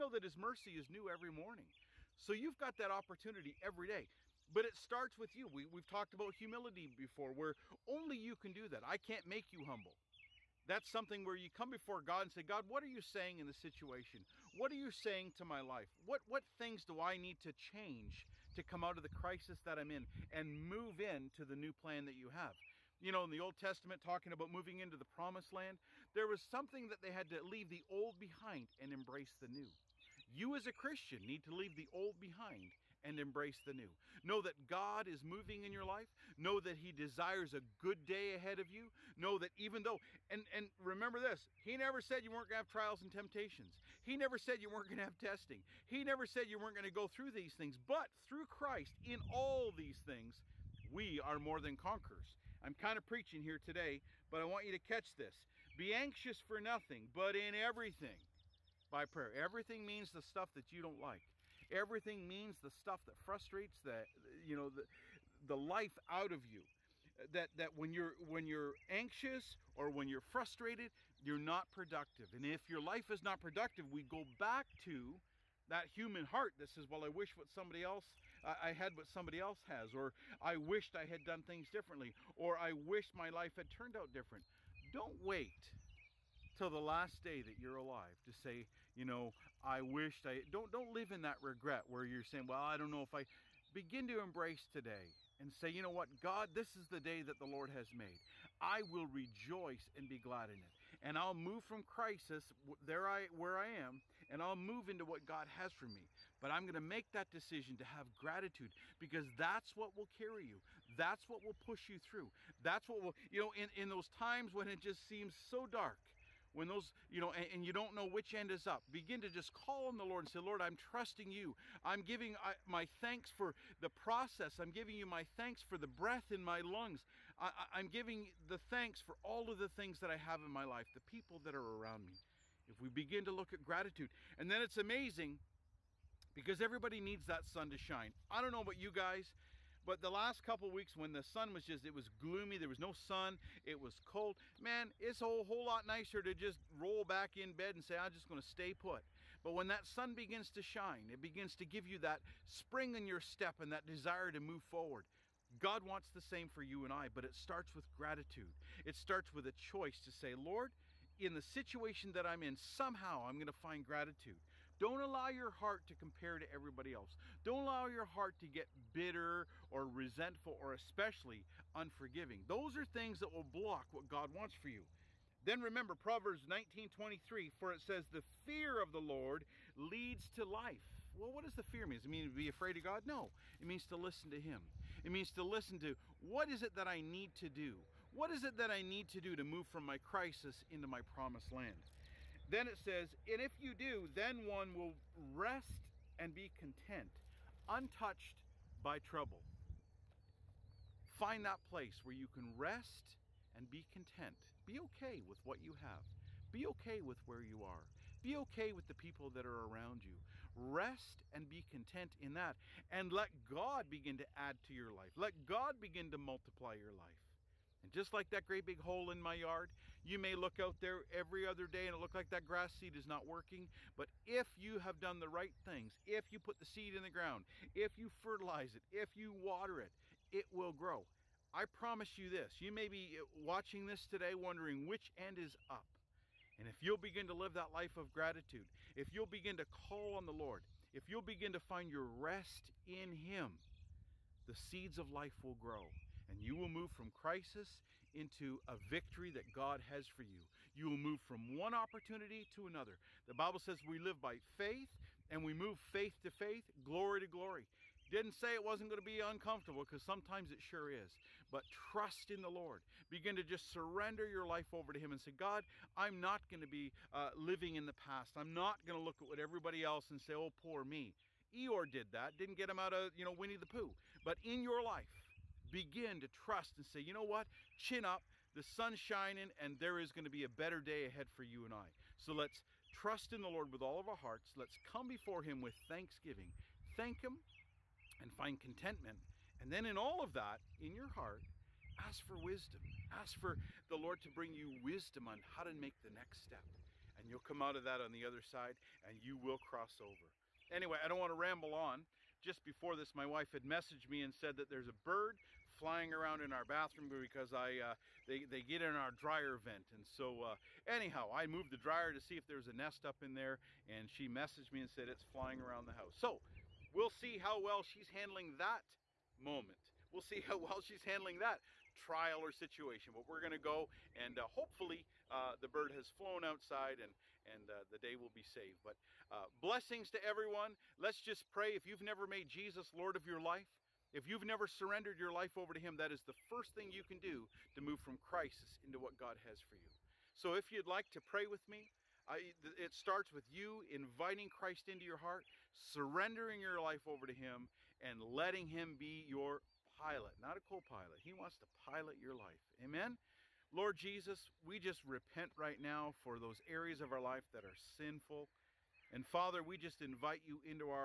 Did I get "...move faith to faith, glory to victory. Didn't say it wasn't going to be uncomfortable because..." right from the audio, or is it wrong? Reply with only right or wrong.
wrong.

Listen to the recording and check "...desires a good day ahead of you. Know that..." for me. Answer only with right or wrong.
right.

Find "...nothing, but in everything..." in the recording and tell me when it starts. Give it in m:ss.
0:56.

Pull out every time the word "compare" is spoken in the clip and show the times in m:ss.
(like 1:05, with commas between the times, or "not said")
2:45.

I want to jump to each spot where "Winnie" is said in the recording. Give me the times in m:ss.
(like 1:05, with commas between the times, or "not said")
4:33.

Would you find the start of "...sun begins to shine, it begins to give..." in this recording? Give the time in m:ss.
2:29.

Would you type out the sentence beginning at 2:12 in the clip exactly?
If we begin to look at gratitude, and then it's amazing because everybody needs that sun to shine.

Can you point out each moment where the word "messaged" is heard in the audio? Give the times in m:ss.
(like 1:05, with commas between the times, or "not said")
5:03, 5:14.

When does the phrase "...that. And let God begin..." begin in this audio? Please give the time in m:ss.
3:32.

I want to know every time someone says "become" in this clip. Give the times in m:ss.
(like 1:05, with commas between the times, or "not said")
not said.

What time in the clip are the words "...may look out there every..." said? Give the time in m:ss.
3:40.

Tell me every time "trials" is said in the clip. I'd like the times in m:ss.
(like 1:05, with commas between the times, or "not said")
0:42, 5:21.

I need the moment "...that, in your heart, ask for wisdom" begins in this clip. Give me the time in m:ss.
4:50.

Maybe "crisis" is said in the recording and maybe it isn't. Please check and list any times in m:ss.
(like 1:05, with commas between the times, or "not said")
0:19, 1:41, 3:09, 4:07, 5:38.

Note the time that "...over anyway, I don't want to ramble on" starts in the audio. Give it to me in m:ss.
5:00.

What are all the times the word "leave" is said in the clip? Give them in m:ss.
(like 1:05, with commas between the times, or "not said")
0:27, 0:31.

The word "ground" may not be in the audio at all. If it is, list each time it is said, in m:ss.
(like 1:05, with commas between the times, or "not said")
3:47.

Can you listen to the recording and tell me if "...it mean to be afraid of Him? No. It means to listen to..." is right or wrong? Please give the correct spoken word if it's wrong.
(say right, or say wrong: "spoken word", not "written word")
wrong: "God", not "Him".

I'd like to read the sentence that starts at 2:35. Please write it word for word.
God wants the same for you and I, but it starts with gratitude.